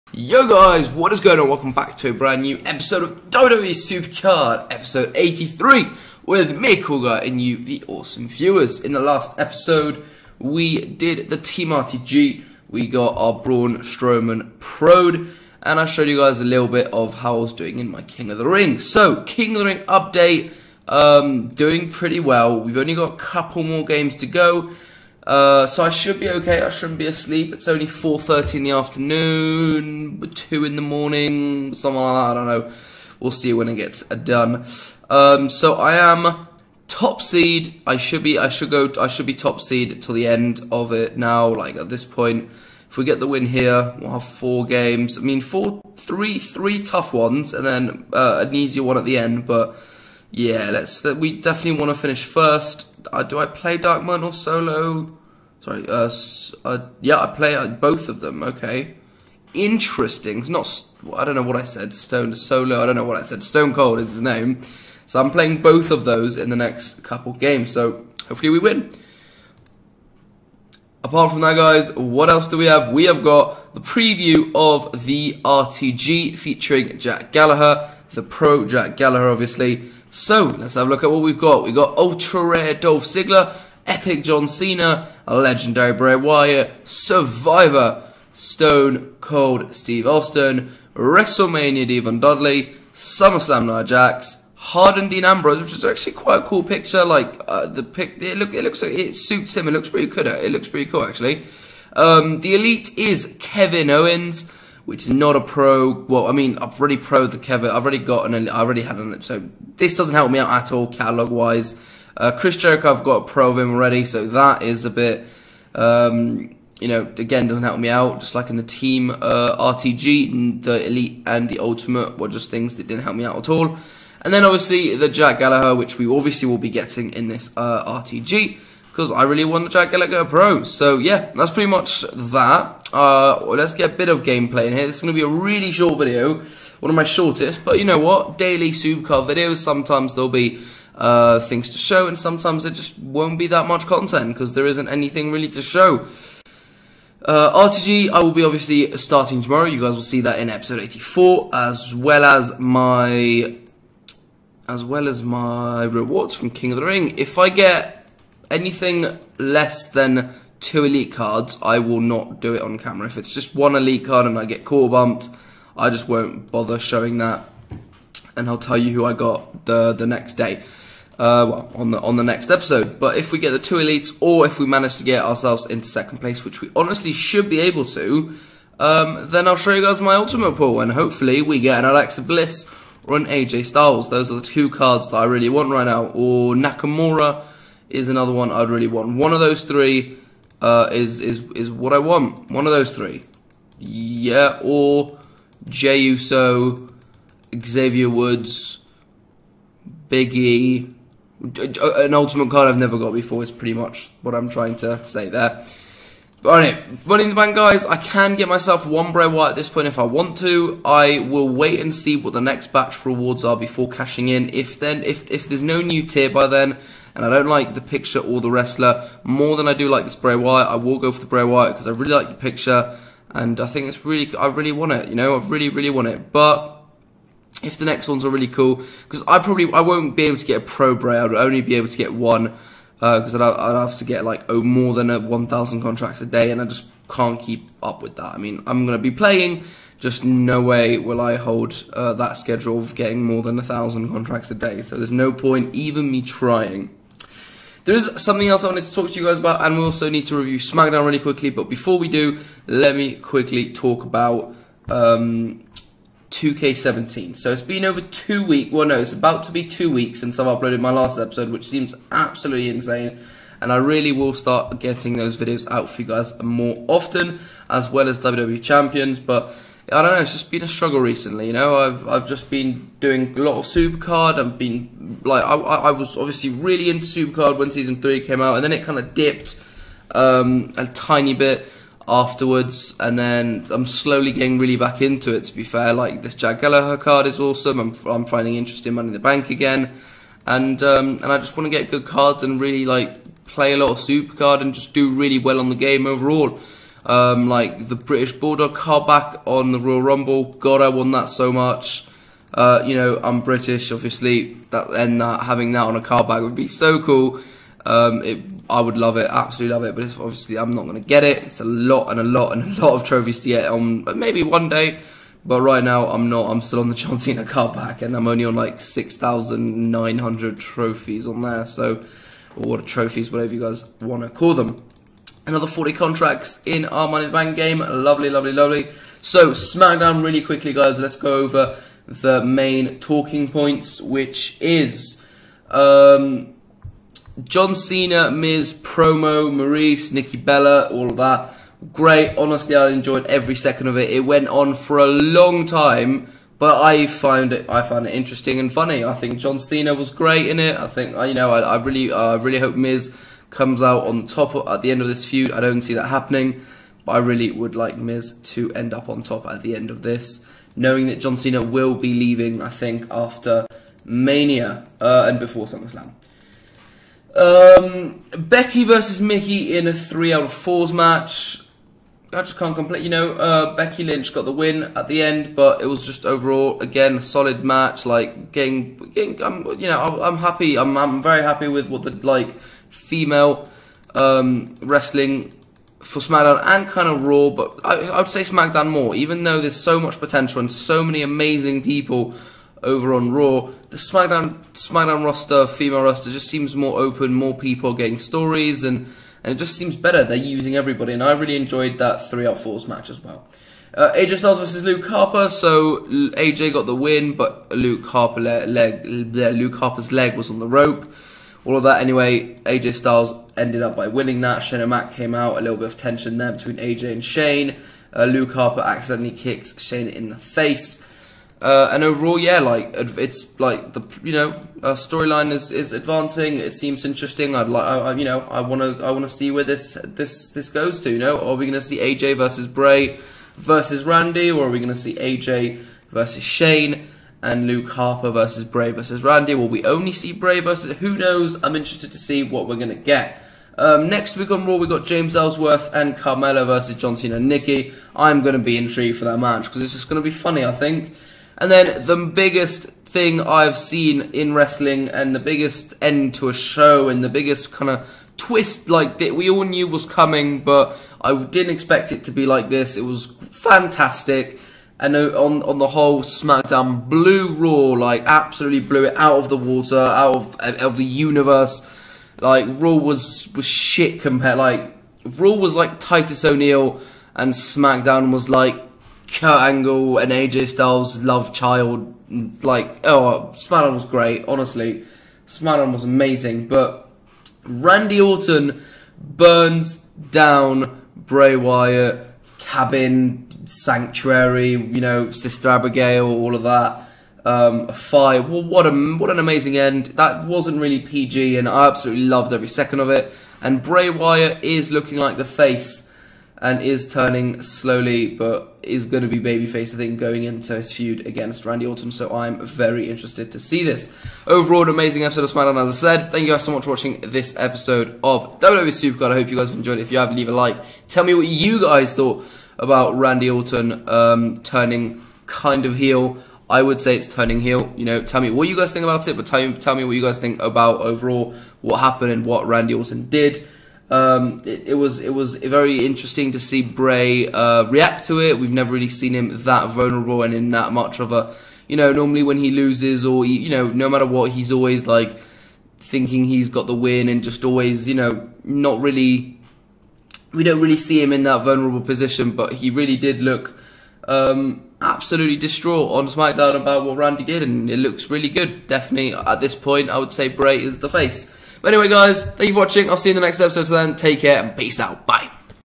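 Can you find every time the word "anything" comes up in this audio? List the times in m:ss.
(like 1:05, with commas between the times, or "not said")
2:24, 2:38.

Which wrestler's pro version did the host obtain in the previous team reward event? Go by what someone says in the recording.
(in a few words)
Braun Strowman.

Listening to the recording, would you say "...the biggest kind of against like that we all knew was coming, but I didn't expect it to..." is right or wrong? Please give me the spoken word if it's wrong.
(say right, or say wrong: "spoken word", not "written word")
wrong: "twist", not "against".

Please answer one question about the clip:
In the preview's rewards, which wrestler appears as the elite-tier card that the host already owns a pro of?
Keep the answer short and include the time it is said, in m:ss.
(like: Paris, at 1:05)
Kevin Owens, at 1:43.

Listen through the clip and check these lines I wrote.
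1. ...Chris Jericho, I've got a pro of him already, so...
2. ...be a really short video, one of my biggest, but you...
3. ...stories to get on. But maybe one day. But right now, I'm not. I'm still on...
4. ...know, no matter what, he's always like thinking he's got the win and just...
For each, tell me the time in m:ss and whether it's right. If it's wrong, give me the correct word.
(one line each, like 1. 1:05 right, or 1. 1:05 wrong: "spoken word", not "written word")
1. 1:52 right
2. 2:15 wrong: "shortest", not "biggest"
3. 5:13 wrong: "trophies", not "stories"
4. 9:03 right.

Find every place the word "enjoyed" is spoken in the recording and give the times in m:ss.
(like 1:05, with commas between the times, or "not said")
5:42, 6:41, 8:39.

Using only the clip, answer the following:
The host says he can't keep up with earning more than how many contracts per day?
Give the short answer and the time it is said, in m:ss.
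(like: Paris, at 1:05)
1,000, at 3:55.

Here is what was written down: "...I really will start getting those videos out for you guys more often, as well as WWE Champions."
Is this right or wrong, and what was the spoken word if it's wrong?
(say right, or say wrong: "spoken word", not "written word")
right.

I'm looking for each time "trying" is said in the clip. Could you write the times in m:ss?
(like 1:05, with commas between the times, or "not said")
3:24, 4:06.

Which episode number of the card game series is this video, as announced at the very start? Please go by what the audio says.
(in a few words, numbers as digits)
83.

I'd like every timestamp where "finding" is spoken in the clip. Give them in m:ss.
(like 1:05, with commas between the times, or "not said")
4:48.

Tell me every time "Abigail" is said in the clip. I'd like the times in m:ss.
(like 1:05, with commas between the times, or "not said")
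8:15.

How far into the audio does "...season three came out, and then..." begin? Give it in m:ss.
4:37.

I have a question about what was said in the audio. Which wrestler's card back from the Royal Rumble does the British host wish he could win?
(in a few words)
British Bulldog.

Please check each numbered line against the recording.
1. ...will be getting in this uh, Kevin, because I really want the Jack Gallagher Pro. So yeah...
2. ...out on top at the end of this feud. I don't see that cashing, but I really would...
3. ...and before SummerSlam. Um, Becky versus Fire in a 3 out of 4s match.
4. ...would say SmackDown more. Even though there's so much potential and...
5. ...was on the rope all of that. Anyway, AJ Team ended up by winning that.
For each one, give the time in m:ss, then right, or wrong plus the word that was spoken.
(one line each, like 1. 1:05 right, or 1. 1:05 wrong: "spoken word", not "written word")
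1. 2:06 wrong: "RTG", not "Kevin"
2. 5:53 wrong: "happening", not "cashing"
3. 6:05 wrong: "Mickie", not "Fire"
4. 6:28 right
5. 6:50 wrong: "Styles", not "Team".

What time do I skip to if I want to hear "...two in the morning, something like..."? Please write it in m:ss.
0:30.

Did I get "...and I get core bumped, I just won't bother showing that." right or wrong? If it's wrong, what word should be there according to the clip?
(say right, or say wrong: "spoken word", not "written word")
right.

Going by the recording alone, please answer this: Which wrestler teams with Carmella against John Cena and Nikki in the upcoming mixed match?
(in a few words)
James Ellsworth.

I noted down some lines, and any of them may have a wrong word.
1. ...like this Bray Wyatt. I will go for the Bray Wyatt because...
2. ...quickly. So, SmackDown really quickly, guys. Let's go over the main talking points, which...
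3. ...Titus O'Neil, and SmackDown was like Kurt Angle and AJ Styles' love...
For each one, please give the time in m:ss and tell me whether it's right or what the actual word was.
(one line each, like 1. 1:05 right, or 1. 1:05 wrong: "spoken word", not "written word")
1. 3:39 right
2. 5:28 wrong: "lovely", not "quickly"
3. 7:55 right.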